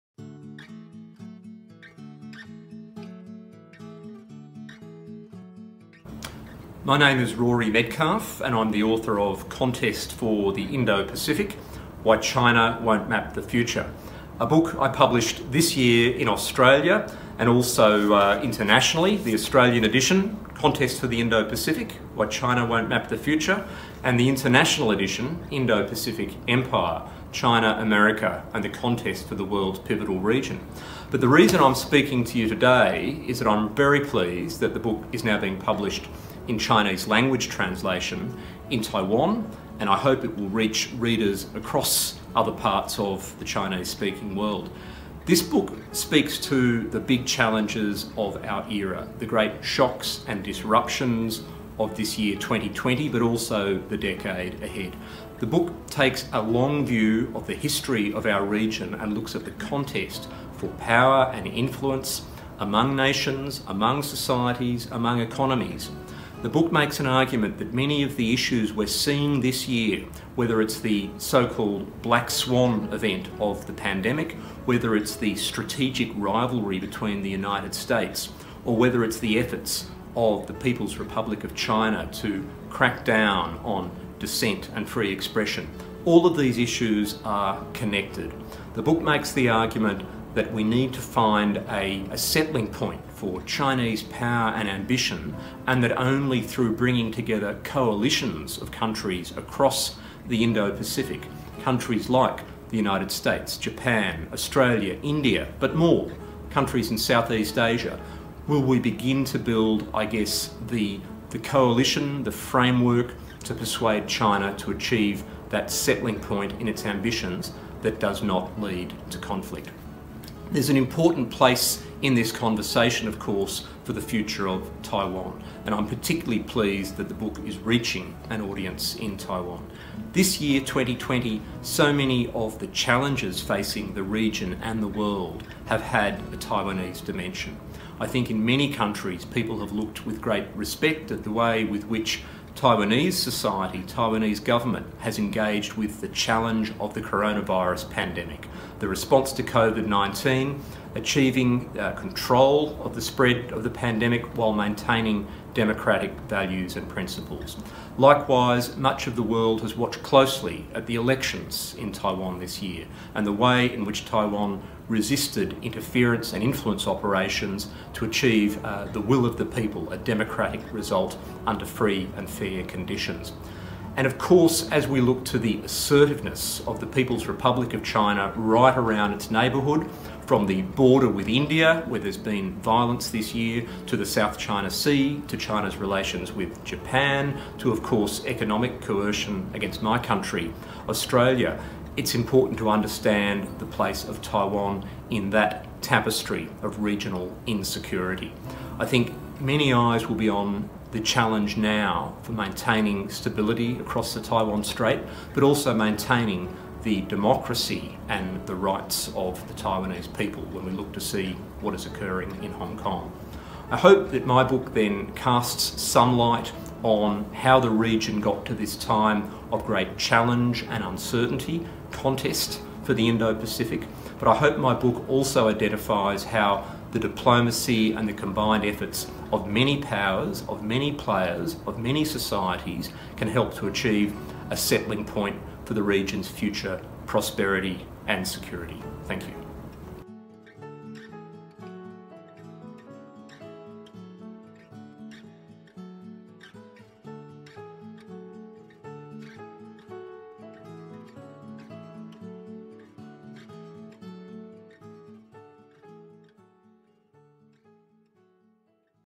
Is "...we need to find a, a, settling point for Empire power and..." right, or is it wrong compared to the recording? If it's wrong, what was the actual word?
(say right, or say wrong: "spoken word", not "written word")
wrong: "Chinese", not "Empire".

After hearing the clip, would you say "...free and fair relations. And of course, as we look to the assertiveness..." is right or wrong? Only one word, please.
wrong.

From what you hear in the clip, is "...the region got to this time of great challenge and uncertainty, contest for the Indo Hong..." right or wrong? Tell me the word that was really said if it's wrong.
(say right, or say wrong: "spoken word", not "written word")
wrong: "Pacific", not "Hong".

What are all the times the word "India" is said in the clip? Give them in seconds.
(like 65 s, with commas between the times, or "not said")
105 s, 181 s.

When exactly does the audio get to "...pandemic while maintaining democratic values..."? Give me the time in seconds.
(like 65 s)
153 s.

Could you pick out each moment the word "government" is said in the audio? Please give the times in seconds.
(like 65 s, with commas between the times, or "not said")
144 s.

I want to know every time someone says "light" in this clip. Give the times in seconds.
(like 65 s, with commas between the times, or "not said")
216 s.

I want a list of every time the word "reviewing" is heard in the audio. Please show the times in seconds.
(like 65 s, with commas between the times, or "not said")
not said.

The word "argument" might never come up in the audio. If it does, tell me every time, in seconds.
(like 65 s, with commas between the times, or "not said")
67 s, 89 s.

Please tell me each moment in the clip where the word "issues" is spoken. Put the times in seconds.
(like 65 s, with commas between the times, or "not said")
68 s, 86 s.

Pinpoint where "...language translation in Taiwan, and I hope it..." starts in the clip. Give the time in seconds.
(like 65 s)
37 s.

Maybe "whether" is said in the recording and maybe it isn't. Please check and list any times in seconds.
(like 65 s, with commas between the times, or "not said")
70 s, 74 s, 78 s.